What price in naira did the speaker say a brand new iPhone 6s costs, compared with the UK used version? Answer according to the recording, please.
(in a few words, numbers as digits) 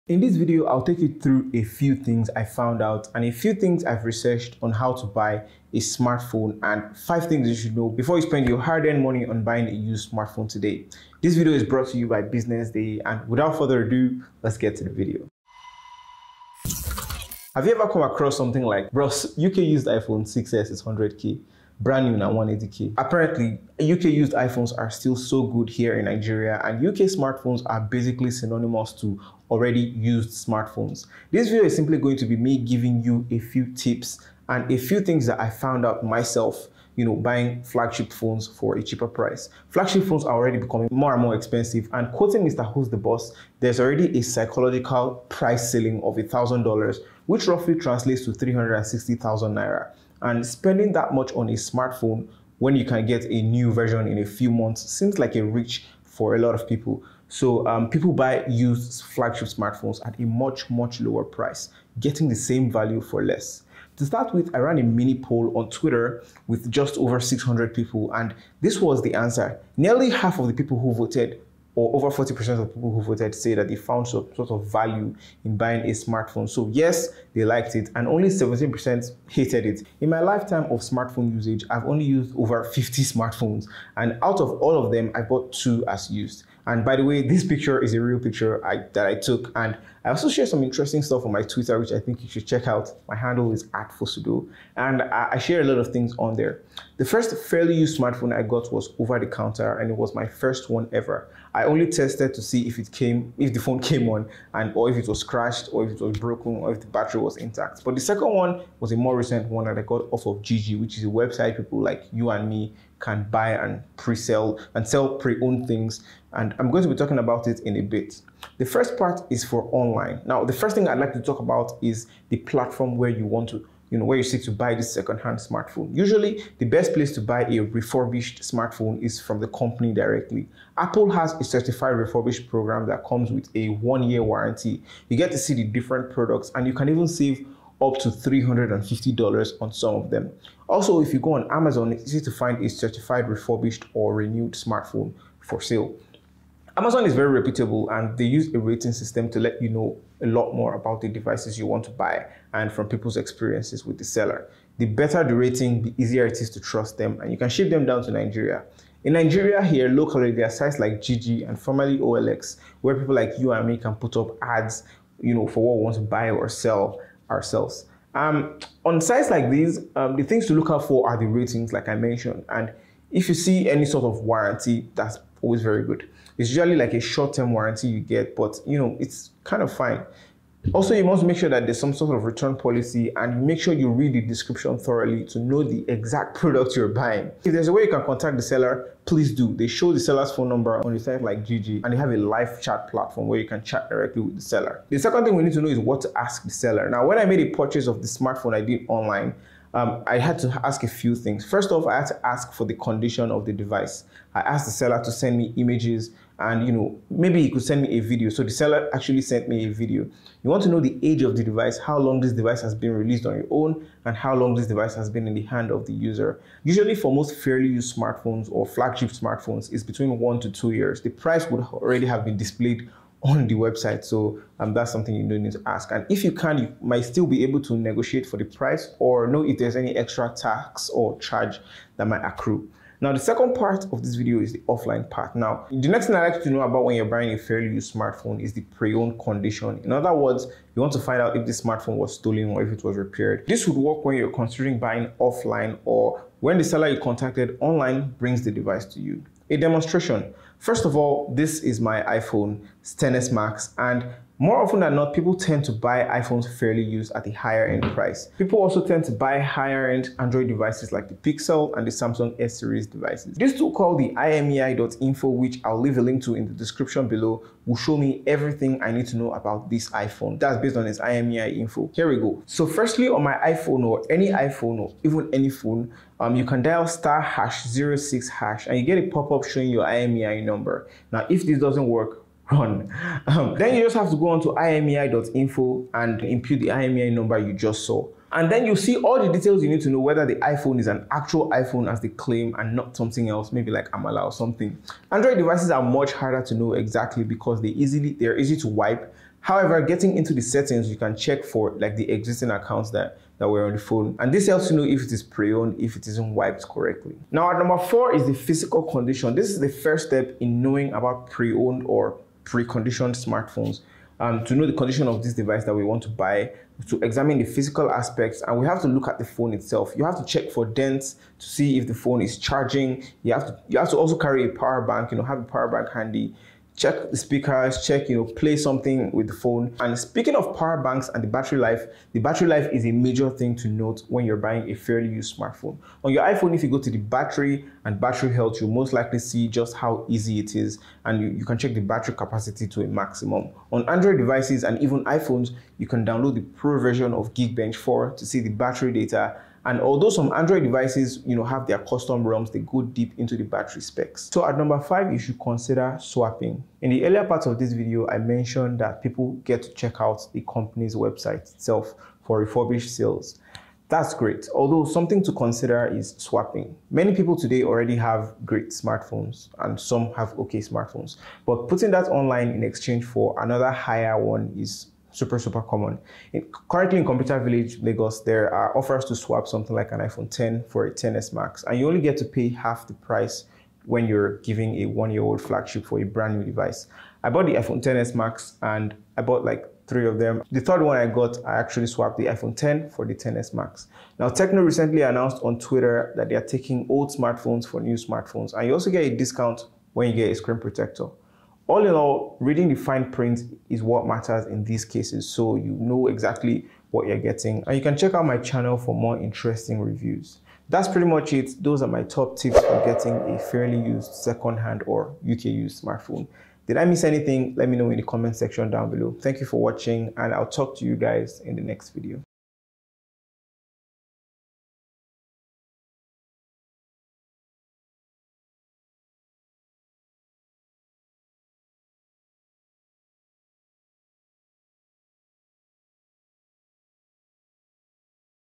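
180k.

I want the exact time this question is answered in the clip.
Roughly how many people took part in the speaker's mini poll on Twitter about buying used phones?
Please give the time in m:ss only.
1:07.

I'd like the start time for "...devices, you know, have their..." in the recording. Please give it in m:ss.
5:50.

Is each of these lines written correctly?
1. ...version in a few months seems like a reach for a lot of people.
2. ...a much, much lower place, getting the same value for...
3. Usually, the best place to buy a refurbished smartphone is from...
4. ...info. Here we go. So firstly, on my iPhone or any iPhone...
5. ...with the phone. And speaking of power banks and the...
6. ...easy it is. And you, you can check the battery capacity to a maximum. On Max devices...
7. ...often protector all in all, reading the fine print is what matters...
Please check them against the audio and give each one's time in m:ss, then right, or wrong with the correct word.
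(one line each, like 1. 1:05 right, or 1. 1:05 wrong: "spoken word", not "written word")
1. 0:53 right
2. 1:00 wrong: "price", not "place"
3. 2:05 right
4. 4:31 right
5. 5:29 right
6. 5:40 wrong: "Android", not "Max"
7. 6:40 wrong: "screen", not "often".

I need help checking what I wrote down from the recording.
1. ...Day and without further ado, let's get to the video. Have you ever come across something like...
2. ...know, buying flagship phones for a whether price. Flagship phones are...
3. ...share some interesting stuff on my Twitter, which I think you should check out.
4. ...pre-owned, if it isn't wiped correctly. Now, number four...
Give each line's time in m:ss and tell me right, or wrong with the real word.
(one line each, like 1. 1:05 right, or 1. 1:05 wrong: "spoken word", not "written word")
1. 0:12 right
2. 0:37 wrong: "cheaper", not "whether"
3. 1:30 right
4. 5:05 right.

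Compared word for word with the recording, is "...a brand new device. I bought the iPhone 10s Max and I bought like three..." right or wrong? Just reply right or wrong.
right.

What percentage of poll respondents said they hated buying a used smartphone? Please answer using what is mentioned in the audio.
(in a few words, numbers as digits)
17%.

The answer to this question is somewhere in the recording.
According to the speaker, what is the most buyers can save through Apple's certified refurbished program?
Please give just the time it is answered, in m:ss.
2:18.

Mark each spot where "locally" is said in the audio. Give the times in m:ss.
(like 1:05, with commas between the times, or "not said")
2:39.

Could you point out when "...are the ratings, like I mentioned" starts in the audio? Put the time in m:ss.
2:51.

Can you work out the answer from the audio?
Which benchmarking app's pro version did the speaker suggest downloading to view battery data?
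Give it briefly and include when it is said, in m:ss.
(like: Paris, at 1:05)
Geekbench 4, at 5:47.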